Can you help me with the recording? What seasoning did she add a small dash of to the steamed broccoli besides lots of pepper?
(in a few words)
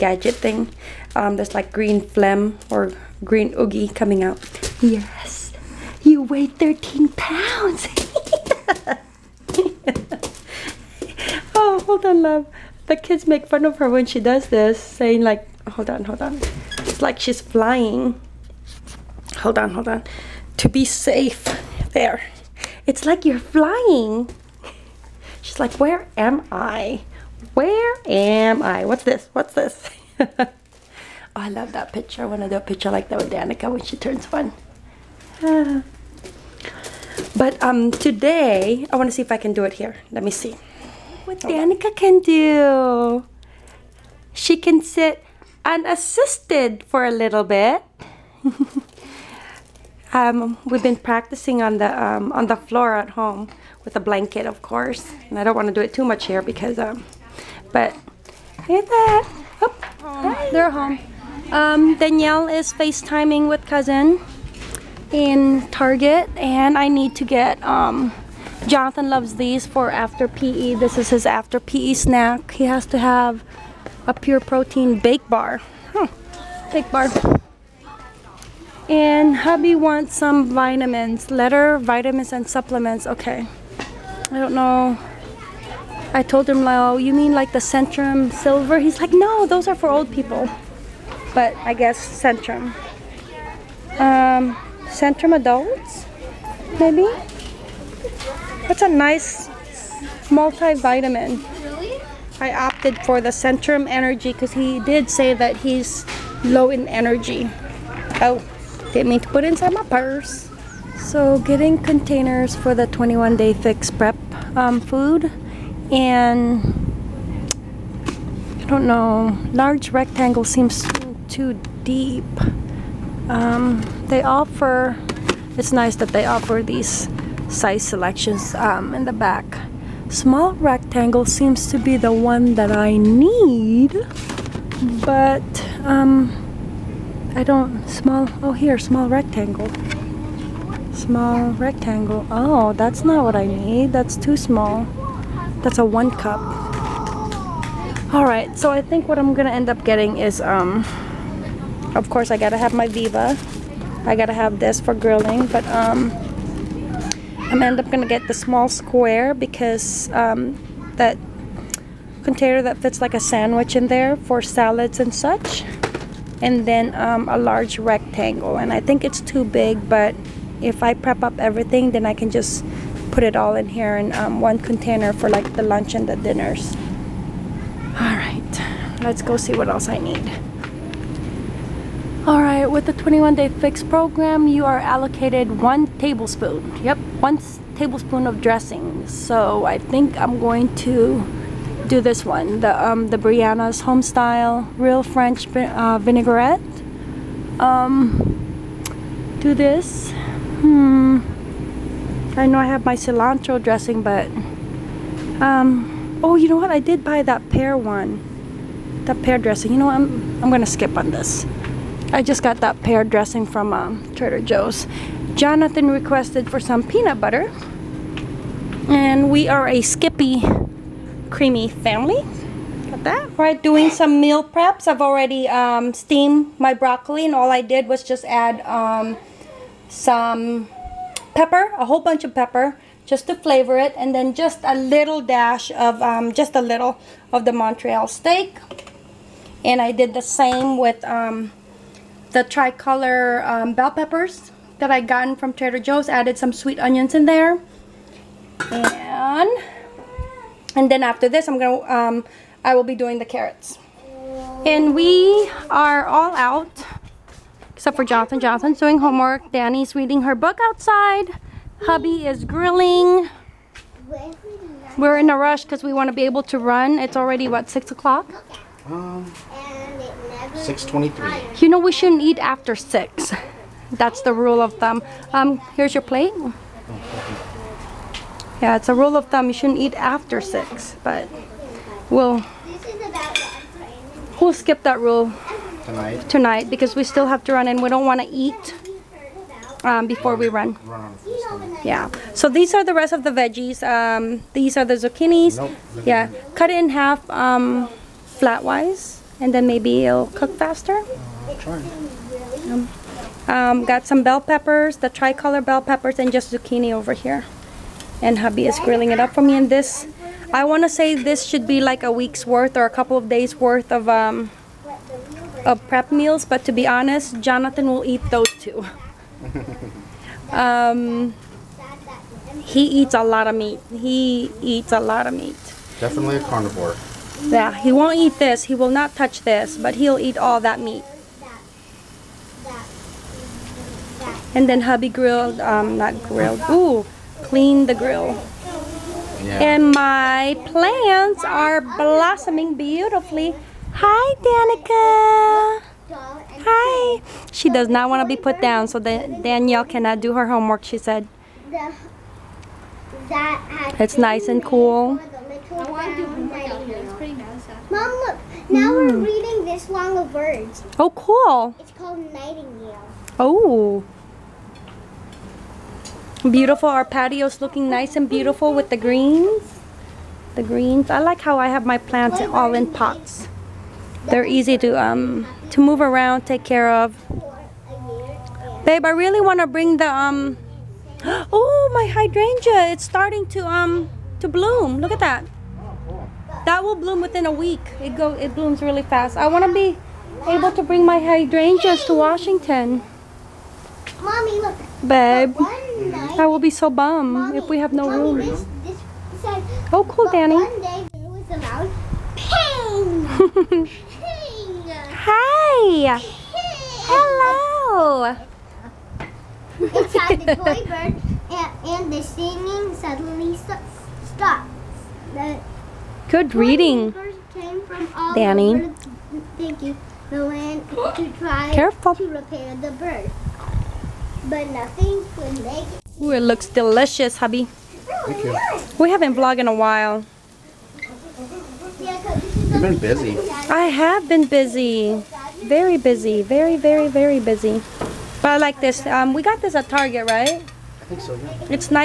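Montreal steak.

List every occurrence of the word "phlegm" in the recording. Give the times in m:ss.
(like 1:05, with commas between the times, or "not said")
0:02.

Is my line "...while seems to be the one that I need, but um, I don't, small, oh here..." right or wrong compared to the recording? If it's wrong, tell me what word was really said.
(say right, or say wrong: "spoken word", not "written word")
wrong: "rectangle", not "while".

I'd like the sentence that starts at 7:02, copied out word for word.
to repair the bird but nothing could make it.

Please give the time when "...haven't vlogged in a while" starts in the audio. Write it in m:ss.
7:09.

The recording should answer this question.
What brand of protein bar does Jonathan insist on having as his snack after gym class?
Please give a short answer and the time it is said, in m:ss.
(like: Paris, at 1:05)
Pure Protein, at 1:14.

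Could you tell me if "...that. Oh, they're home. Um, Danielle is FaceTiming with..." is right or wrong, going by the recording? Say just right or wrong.
right.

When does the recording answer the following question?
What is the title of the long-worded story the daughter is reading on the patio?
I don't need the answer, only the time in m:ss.
6:02.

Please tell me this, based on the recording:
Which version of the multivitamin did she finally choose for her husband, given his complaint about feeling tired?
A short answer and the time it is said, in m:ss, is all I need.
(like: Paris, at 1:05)
Centrum Energy, at 1:43.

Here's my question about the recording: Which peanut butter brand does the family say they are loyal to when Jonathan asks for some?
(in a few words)
Skippy.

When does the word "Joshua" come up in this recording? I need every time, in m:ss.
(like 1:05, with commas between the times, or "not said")
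not said.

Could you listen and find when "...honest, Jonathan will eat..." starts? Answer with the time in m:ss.
5:16.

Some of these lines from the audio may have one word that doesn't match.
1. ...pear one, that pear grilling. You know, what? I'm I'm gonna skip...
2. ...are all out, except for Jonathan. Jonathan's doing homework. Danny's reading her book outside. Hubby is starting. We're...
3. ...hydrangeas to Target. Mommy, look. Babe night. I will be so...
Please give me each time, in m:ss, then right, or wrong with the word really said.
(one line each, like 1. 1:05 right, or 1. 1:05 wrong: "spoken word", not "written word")
1. 3:27 wrong: "dressing", not "grilling"
2. 4:15 wrong: "grilling", not "starting"
3. 6:31 wrong: "Washington", not "Target".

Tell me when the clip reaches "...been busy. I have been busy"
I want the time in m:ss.
7:12.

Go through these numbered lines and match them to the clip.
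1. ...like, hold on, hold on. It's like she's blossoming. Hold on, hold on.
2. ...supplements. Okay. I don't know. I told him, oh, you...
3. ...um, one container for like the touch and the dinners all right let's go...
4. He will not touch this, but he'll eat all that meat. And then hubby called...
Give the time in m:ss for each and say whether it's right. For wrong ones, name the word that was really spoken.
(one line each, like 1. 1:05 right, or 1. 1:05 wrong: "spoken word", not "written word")
1. 0:15 wrong: "flying", not "blossoming"
2. 1:22 right
3. 2:54 wrong: "lunch", not "touch"
4. 5:28 wrong: "grilled", not "called".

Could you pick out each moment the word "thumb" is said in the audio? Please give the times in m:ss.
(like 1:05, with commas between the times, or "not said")
4:34, 4:39.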